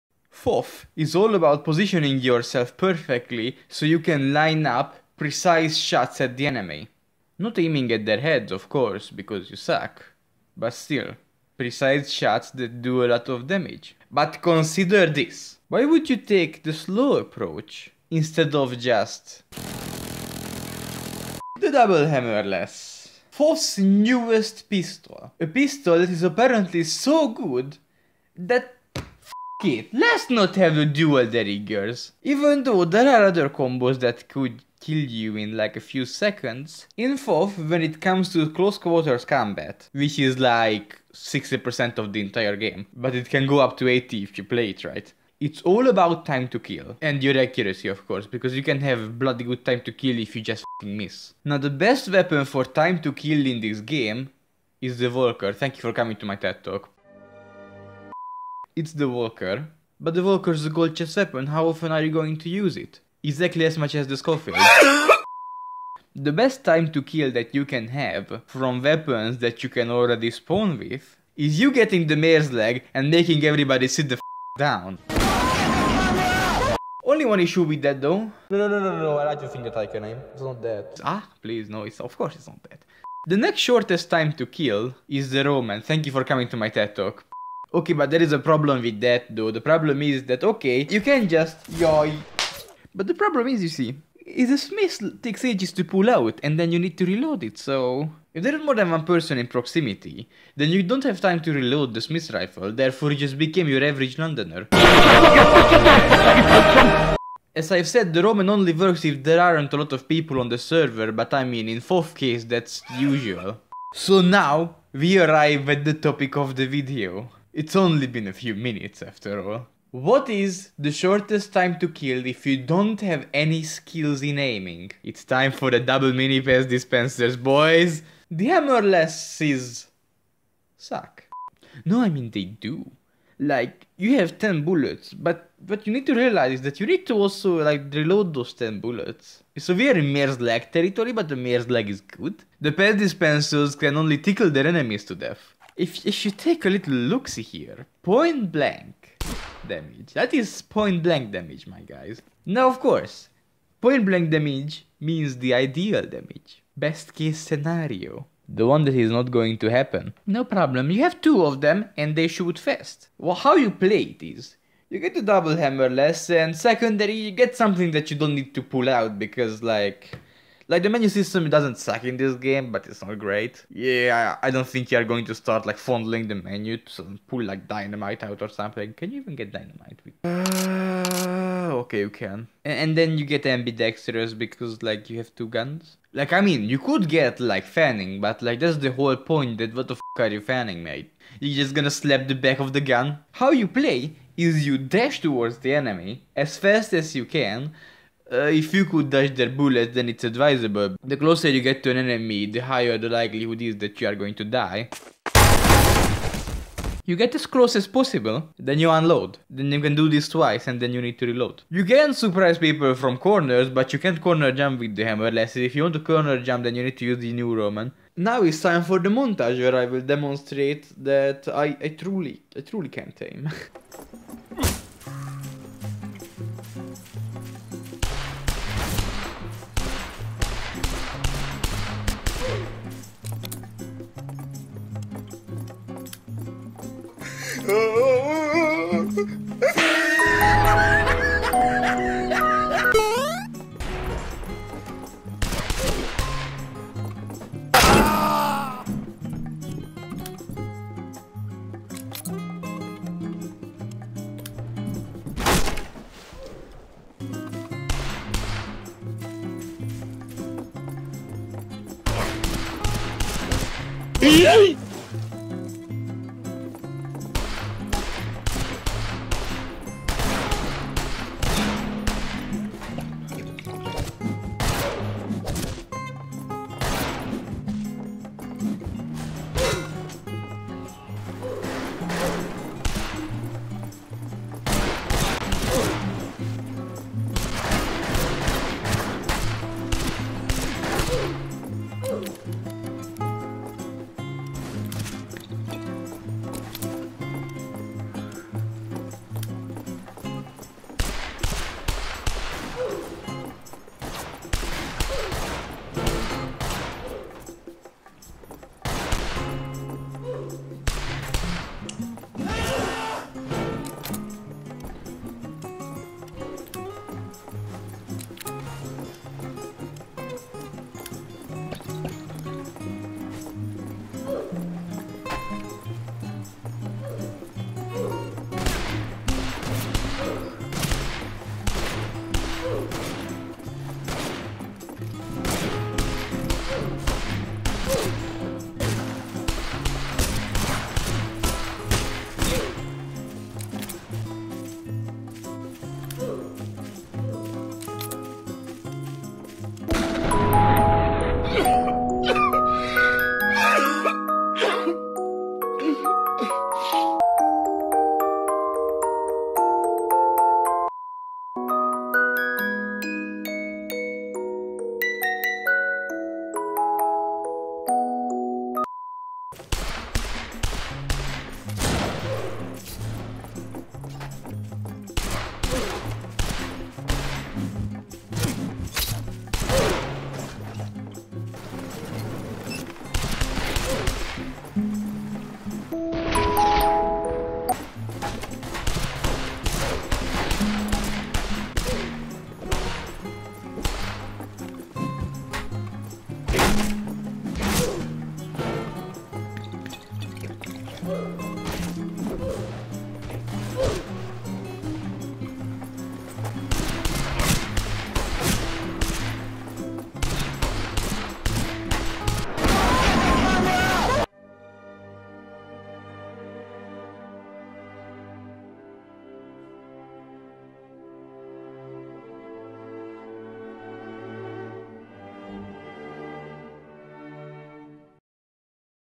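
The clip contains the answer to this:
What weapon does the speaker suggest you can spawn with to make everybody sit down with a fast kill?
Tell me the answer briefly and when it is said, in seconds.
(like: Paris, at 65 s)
mare's leg, at 72 s.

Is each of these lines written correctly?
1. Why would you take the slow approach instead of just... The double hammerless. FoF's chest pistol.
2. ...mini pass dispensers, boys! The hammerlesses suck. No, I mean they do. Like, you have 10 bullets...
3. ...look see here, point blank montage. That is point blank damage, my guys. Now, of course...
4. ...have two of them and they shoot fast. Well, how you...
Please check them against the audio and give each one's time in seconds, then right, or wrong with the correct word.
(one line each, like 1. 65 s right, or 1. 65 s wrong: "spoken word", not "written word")
1. 15 s wrong: "newest", not "chest"
2. 126 s right
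3. 146 s wrong: "damage", not "montage"
4. 161 s right.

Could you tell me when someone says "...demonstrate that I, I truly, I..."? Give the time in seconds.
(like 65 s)
220 s.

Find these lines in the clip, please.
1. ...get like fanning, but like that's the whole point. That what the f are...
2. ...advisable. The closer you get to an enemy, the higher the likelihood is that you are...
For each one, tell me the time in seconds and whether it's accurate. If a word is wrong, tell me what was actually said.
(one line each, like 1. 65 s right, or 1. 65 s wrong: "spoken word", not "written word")
1. 187 s right
2. 200 s right.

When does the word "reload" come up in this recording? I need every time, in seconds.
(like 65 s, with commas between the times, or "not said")
97 s, 101 s, 137 s, 211 s.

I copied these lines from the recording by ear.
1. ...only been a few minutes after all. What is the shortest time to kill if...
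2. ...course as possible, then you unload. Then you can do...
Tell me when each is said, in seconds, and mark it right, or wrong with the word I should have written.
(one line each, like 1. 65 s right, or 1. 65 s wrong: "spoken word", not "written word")
1. 117 s right
2. 207 s wrong: "close", not "course".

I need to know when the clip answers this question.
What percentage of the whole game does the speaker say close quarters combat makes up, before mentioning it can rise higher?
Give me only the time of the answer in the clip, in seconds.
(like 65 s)
41 s.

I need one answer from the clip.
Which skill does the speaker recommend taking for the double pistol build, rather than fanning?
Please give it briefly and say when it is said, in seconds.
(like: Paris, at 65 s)
ambidextrous, at 183 s.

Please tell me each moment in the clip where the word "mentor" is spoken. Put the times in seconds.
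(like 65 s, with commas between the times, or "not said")
not said.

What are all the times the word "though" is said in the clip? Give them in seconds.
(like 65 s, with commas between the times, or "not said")
32 s, 78 s, 89 s.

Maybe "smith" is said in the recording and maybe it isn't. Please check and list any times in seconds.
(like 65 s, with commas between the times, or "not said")
94 s, 102 s.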